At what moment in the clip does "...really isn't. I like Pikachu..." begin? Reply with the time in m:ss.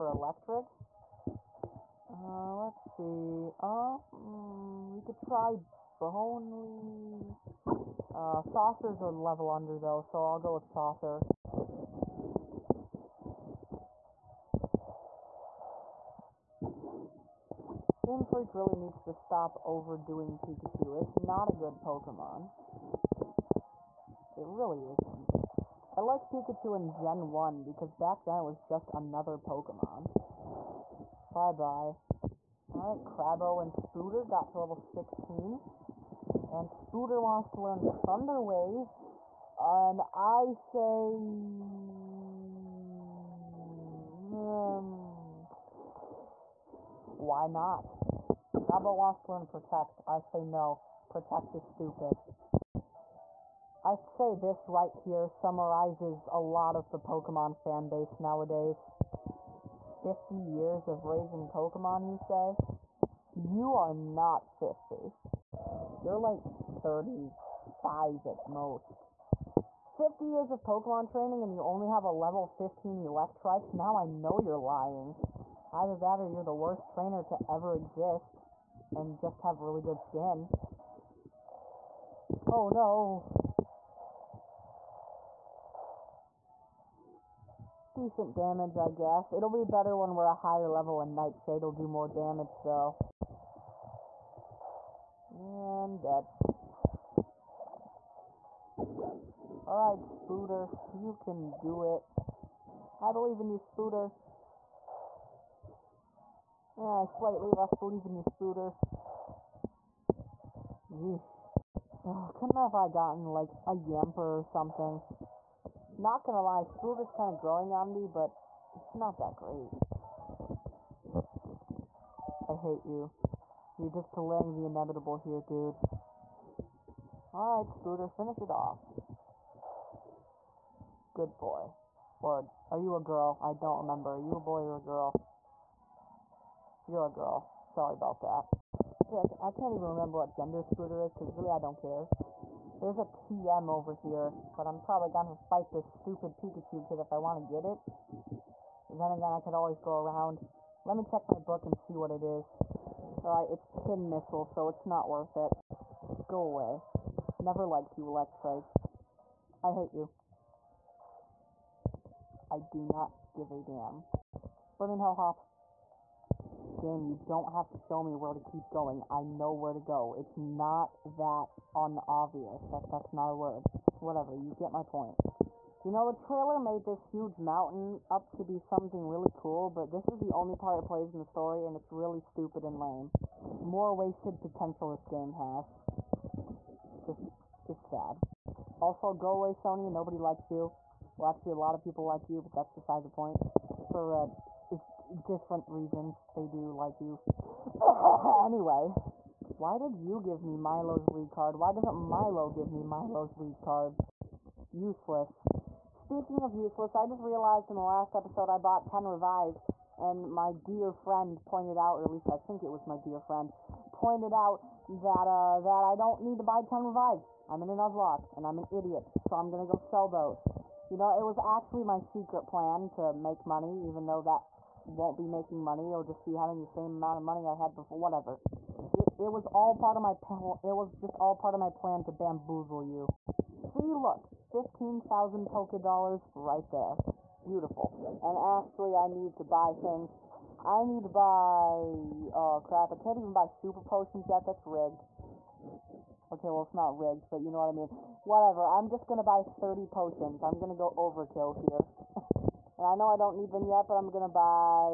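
0:24.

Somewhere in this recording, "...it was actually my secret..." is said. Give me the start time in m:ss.
3:41.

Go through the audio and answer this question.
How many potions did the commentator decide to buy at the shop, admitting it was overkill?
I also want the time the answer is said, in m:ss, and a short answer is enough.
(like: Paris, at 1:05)
30, at 4:09.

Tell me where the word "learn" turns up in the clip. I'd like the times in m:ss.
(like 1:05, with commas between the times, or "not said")
0:37, 0:49.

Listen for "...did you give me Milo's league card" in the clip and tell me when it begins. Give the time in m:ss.
3:19.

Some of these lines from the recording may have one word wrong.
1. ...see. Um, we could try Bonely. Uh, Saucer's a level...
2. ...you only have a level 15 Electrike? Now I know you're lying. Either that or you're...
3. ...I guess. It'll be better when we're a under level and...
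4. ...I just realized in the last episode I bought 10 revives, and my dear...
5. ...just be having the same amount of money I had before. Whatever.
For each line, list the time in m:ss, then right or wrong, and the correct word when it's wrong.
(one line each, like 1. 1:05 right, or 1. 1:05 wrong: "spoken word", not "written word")
1. 0:02 right
2. 1:11 right
3. 1:28 wrong: "higher", not "under"
4. 3:26 right
5. 3:46 right.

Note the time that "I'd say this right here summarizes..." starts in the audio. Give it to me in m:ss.
0:53.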